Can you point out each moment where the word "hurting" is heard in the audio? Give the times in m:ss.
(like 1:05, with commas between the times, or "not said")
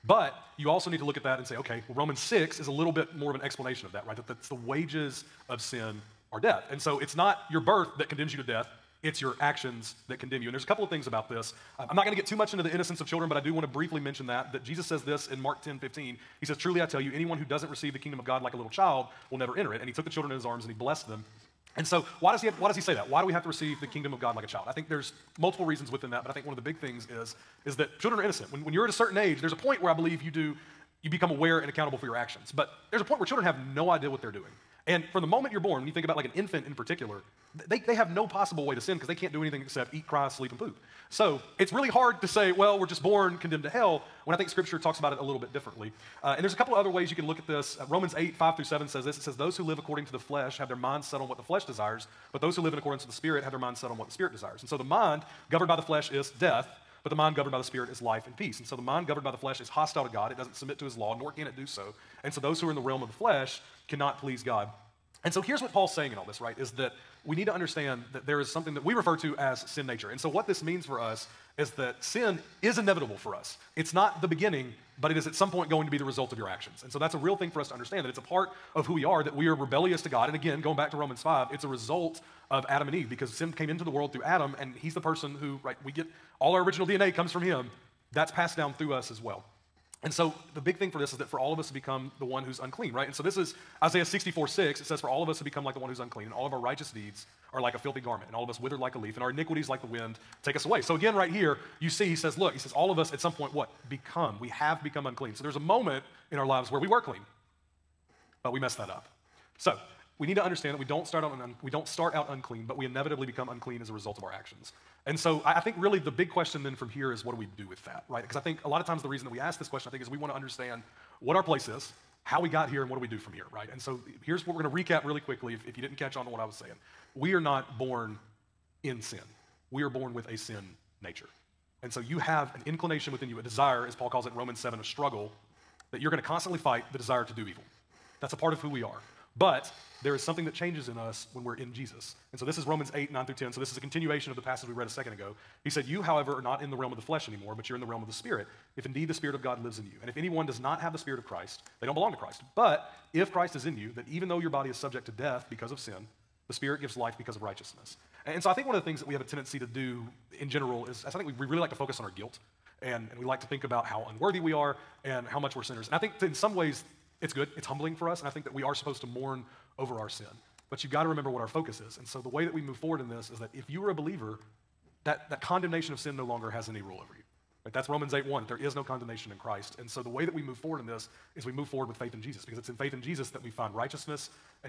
not said.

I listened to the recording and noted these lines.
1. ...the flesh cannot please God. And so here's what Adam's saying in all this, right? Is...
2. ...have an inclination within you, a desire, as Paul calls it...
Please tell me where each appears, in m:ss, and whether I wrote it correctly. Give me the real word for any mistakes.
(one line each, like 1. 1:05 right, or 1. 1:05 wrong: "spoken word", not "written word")
1. 1:03 wrong: "Paul", not "Adam"
2. 2:12 right.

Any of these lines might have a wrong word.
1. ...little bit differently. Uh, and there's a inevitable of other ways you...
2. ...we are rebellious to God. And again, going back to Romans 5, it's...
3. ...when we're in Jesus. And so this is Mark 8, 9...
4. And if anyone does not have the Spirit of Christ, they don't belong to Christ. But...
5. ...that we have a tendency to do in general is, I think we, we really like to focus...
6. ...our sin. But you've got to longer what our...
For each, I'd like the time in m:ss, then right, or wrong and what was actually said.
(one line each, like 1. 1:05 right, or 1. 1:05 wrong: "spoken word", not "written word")
1. 0:45 wrong: "couple", not "inevitable"
2. 1:19 right
3. 2:21 wrong: "Romans", not "Mark"
4. 2:30 right
5. 2:38 right
6. 2:49 wrong: "remember", not "longer".